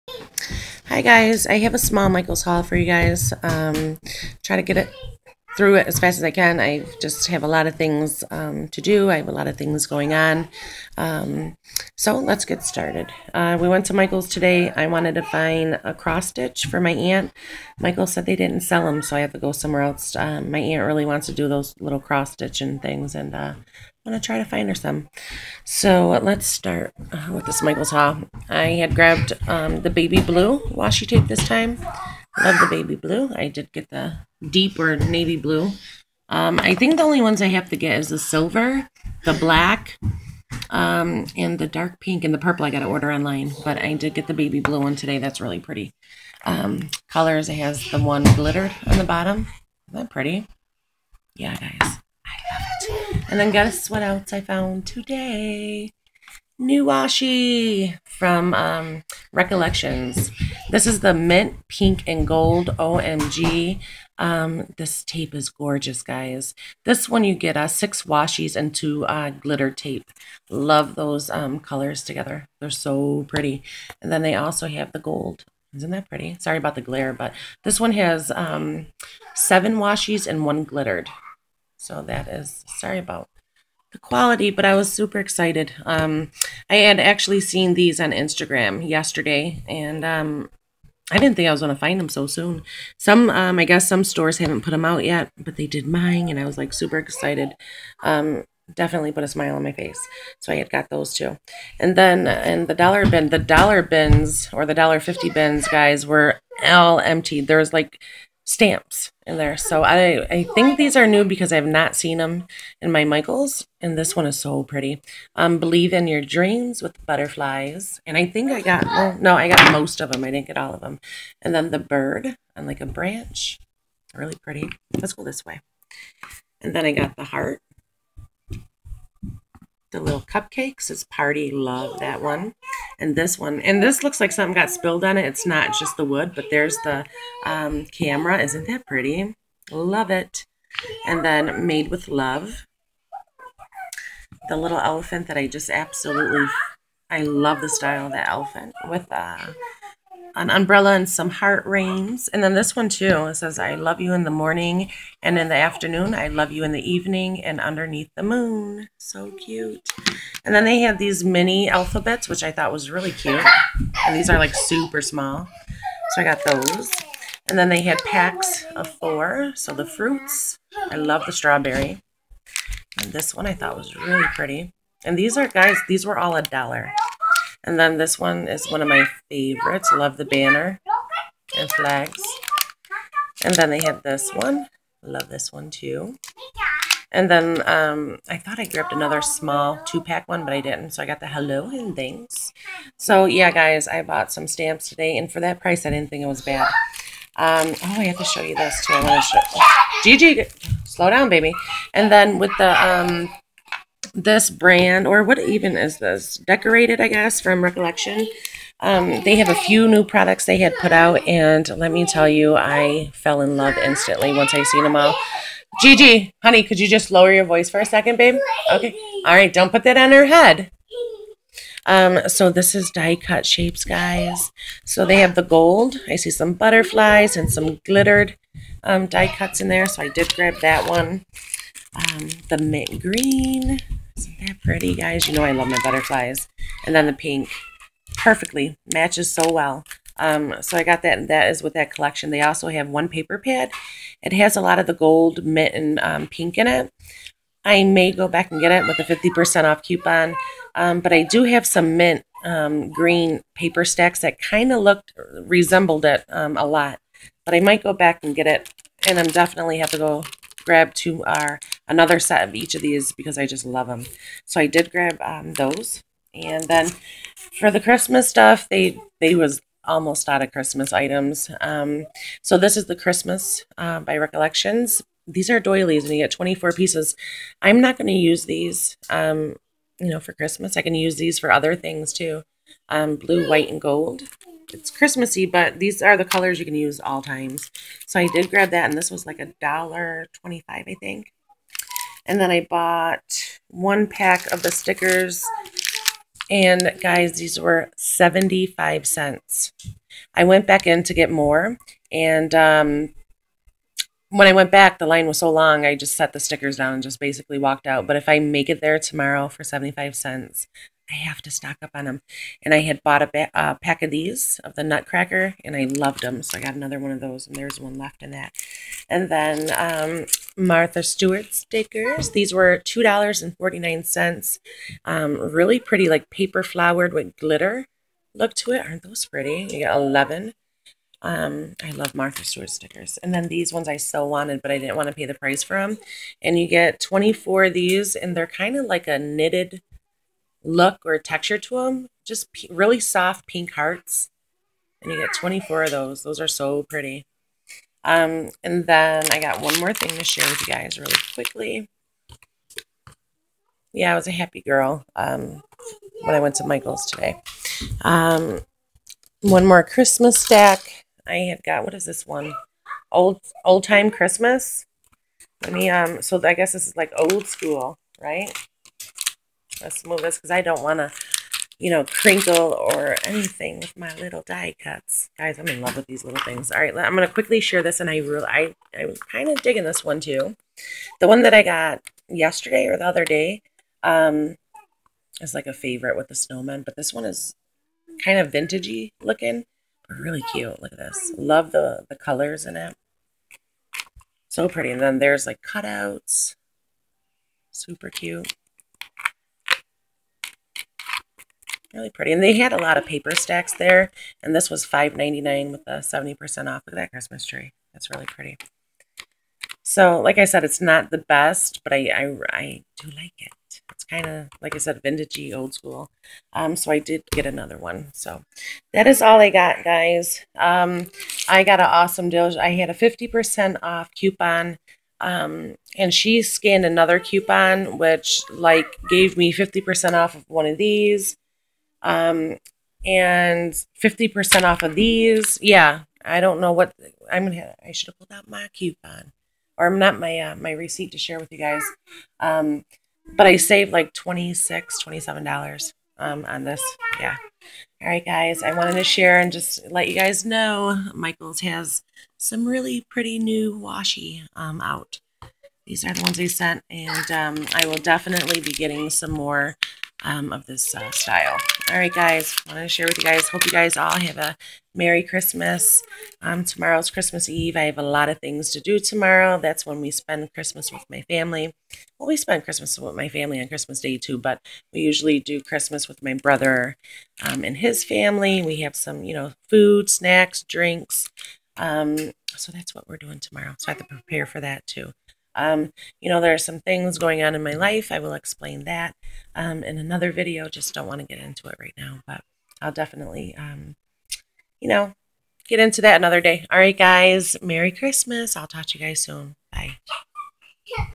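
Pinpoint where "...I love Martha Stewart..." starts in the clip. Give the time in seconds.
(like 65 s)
331 s.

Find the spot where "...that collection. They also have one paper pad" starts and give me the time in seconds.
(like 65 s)
241 s.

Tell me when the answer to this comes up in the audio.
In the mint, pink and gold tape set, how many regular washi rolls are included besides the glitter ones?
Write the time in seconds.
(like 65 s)
67 s.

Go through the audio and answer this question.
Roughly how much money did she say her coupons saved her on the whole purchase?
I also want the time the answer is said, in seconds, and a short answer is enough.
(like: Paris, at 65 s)
26 to 27 dollars, at 444 s.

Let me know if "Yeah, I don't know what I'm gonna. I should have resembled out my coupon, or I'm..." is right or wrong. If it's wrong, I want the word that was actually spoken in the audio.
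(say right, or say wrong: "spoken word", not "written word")
wrong: "pulled", not "resembled".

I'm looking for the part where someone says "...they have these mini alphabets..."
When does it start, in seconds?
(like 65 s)
160 s.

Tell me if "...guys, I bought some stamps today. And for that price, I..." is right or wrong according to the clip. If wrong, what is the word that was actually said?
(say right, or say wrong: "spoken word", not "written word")
right.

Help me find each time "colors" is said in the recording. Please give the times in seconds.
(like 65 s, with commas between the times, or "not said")
47 s, 71 s, 286 s, 392 s.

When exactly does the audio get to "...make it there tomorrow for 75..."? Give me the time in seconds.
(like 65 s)
308 s.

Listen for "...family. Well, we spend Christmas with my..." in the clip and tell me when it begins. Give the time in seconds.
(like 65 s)
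471 s.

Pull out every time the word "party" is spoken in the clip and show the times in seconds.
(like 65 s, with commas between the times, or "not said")
131 s.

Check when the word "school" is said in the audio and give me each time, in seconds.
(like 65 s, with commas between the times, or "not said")
367 s, 415 s.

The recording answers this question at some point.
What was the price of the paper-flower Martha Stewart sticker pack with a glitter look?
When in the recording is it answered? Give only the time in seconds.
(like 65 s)
322 s.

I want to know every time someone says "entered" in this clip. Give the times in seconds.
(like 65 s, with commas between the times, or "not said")
not said.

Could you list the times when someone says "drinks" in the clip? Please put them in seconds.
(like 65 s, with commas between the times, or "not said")
480 s.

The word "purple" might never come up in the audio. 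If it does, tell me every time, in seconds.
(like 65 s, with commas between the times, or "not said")
42 s.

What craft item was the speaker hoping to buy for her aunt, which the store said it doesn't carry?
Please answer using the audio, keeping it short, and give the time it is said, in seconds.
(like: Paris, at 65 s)
cross stitch, at 15 s.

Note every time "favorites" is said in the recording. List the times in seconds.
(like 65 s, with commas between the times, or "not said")
179 s, 385 s.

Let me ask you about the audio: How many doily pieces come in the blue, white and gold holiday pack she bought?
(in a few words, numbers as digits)
24.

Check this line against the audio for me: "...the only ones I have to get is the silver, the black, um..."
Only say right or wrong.
right.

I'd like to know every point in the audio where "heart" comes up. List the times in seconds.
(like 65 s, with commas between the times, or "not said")
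127 s, 151 s, 343 s.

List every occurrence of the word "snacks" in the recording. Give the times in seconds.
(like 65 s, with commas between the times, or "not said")
480 s.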